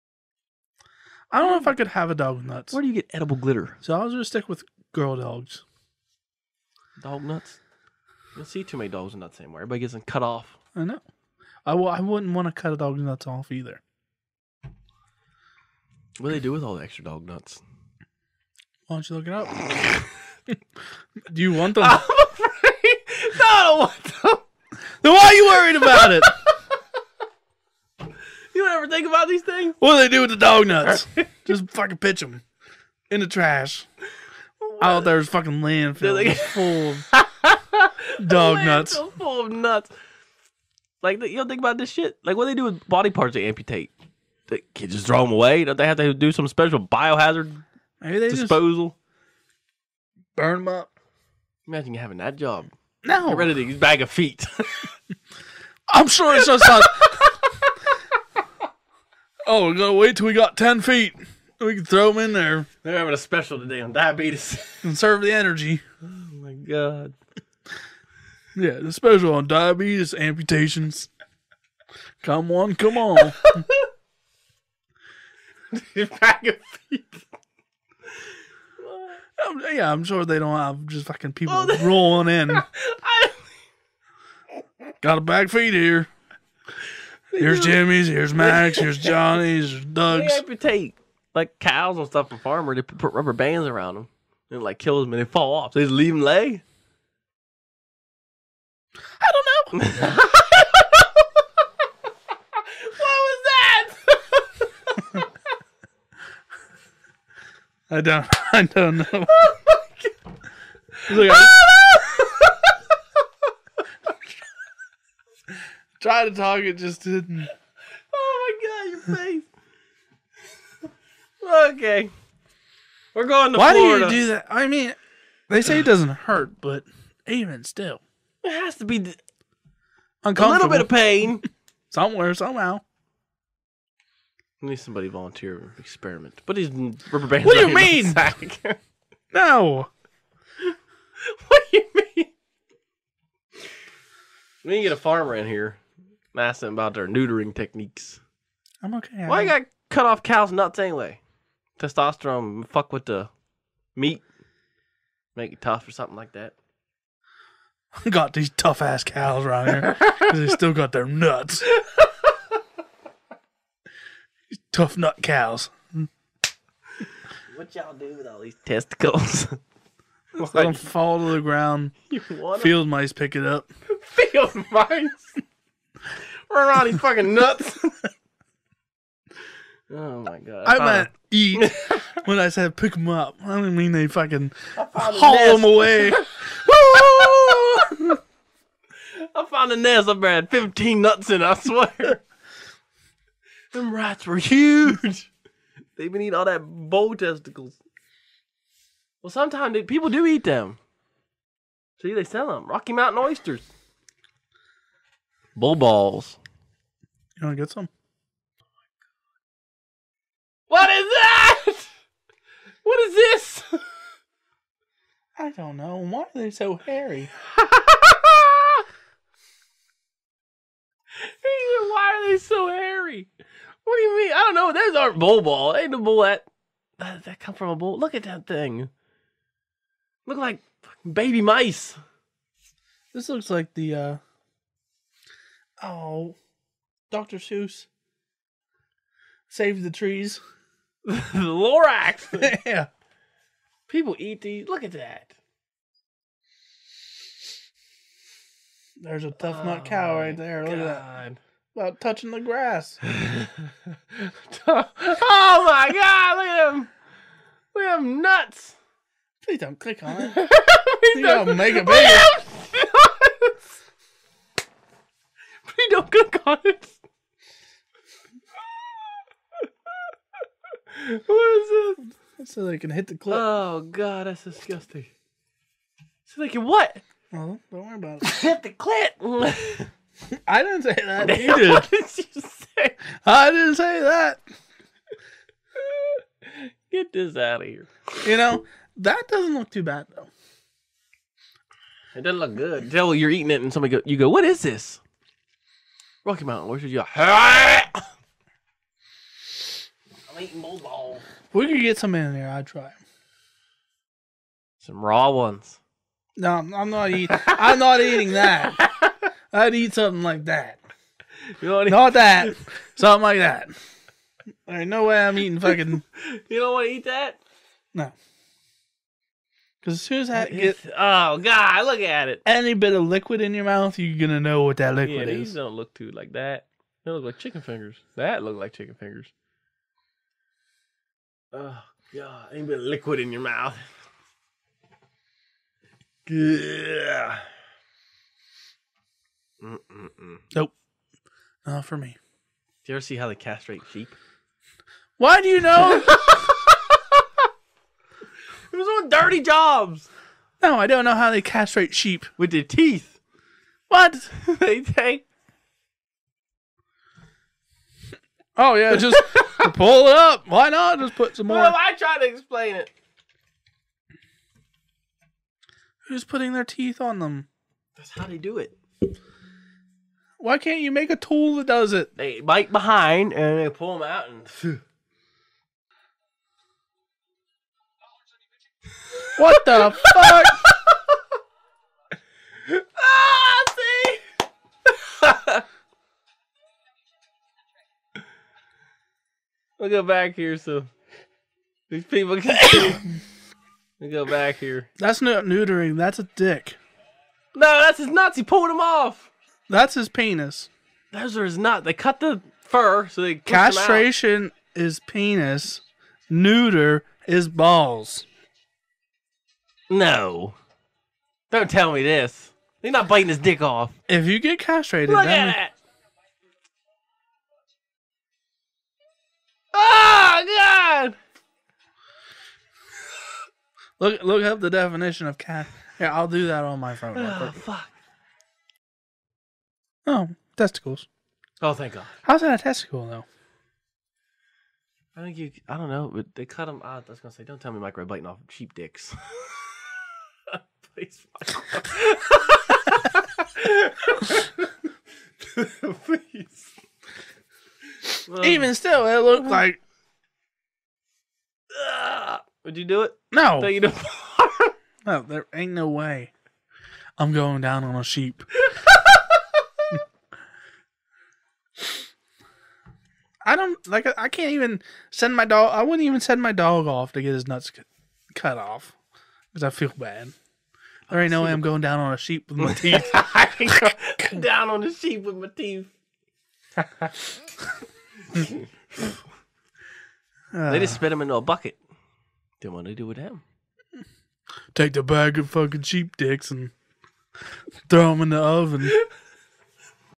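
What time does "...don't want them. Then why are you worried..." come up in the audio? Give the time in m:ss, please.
0:23.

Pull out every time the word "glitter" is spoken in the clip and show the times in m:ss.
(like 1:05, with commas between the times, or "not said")
0:03.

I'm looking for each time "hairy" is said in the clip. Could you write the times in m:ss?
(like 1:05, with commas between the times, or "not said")
3:36, 3:42.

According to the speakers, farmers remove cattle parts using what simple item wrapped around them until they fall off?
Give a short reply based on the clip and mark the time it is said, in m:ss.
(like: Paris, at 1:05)
Rubber bands, at 1:33.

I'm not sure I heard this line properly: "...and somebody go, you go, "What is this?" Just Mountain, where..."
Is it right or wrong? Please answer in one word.
wrong.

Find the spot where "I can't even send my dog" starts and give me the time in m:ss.
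7:44.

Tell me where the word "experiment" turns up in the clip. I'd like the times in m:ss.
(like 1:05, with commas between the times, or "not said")
2:15.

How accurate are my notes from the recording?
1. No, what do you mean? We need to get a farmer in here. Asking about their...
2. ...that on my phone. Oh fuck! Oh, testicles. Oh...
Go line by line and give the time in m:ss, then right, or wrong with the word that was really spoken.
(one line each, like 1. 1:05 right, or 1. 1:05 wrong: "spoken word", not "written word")
1. 2:19 right
2. 7:06 right.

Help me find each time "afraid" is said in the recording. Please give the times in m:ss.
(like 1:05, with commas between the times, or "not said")
0:21.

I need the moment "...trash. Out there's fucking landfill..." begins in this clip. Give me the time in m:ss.
0:33.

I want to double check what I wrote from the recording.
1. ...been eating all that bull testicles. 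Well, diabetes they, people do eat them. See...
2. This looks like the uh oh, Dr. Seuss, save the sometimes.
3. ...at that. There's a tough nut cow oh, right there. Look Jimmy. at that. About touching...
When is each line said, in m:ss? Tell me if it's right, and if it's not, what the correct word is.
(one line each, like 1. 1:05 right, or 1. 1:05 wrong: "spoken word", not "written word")
1. 3:16 wrong: "sometimes", not "diabetes"
2. 3:53 wrong: "trees", not "sometimes"
3. 4:04 wrong: "God", not "Jimmy".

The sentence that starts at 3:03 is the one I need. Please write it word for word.
I do not mean they fucking haul them away.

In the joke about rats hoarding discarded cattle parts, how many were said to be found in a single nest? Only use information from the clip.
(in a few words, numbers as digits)
15.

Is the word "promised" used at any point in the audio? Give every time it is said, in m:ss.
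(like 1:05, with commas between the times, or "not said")
not said.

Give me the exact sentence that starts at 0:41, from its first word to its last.
Like you don't think about this shit.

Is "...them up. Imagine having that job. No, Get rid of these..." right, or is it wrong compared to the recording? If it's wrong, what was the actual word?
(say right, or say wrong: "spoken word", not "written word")
right.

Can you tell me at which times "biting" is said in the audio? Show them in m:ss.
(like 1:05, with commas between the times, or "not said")
6:53, 7:18.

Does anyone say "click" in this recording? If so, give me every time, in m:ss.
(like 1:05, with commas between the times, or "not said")
4:19, 4:26.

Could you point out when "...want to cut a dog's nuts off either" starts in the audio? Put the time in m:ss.
0:12.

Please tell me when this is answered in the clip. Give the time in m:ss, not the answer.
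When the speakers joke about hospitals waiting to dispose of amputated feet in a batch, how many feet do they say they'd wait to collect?
1:00.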